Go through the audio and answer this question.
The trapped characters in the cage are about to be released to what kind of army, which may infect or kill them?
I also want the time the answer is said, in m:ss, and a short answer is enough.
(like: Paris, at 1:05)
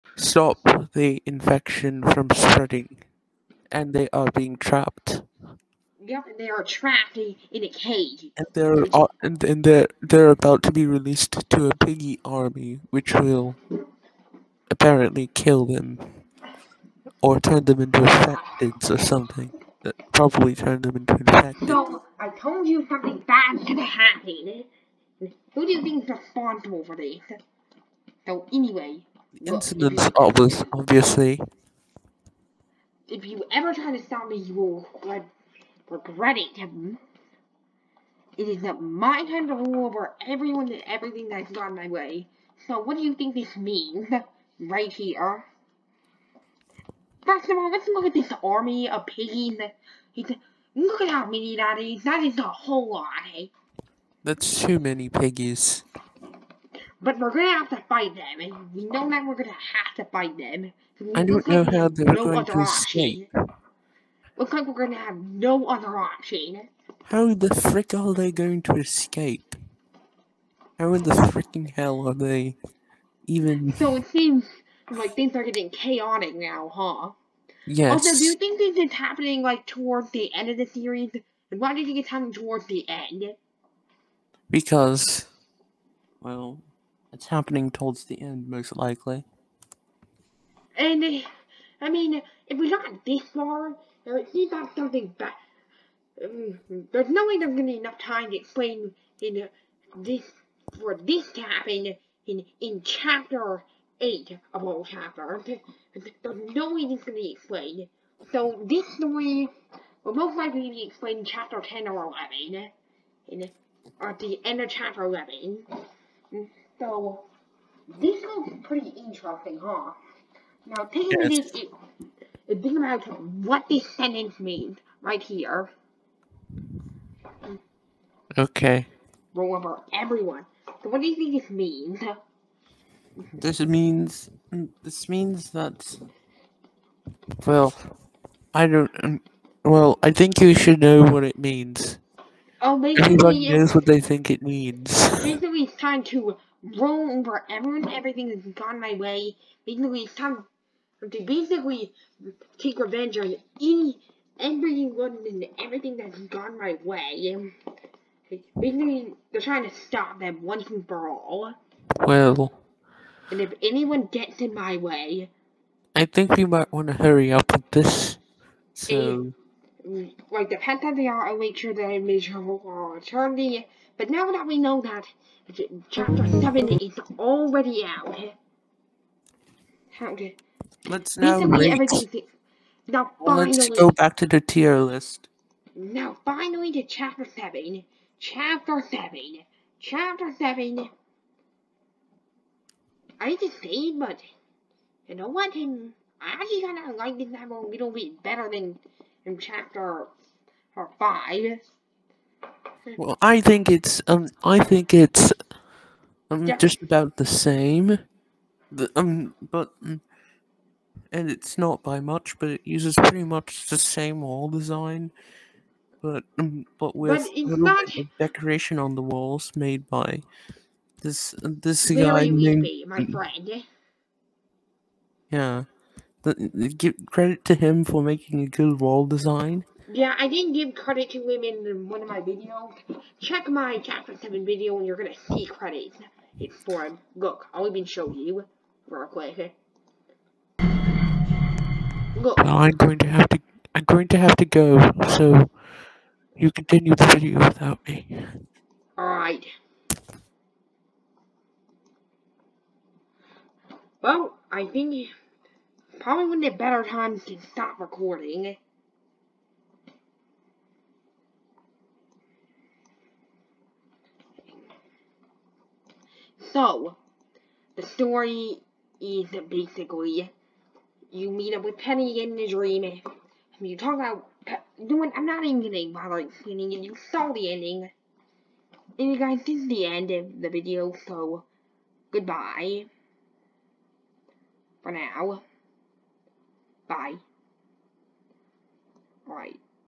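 piggy army, at 0:11.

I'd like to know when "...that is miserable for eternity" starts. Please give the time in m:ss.
2:51.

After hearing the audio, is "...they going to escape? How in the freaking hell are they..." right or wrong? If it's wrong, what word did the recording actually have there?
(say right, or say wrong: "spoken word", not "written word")
right.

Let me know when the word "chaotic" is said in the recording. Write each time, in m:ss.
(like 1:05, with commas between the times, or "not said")
1:15.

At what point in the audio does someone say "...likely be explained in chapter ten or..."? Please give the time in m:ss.
1:50.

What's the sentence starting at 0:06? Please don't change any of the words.
Yep, and they are trapped in a cage.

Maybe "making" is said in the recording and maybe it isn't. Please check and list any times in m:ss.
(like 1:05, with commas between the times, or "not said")
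3:48.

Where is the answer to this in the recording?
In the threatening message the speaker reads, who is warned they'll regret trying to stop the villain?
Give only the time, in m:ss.
0:36.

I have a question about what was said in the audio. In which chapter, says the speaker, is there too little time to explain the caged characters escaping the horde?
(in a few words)
8.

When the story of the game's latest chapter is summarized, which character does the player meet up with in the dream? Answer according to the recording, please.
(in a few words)
Penny.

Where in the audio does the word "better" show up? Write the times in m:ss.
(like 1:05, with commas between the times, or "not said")
3:18, 4:16.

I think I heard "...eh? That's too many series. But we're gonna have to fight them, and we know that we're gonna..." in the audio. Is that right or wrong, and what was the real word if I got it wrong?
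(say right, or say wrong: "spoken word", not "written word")
wrong: "piggies", not "series".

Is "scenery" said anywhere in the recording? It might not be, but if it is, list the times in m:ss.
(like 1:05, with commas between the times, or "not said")
not said.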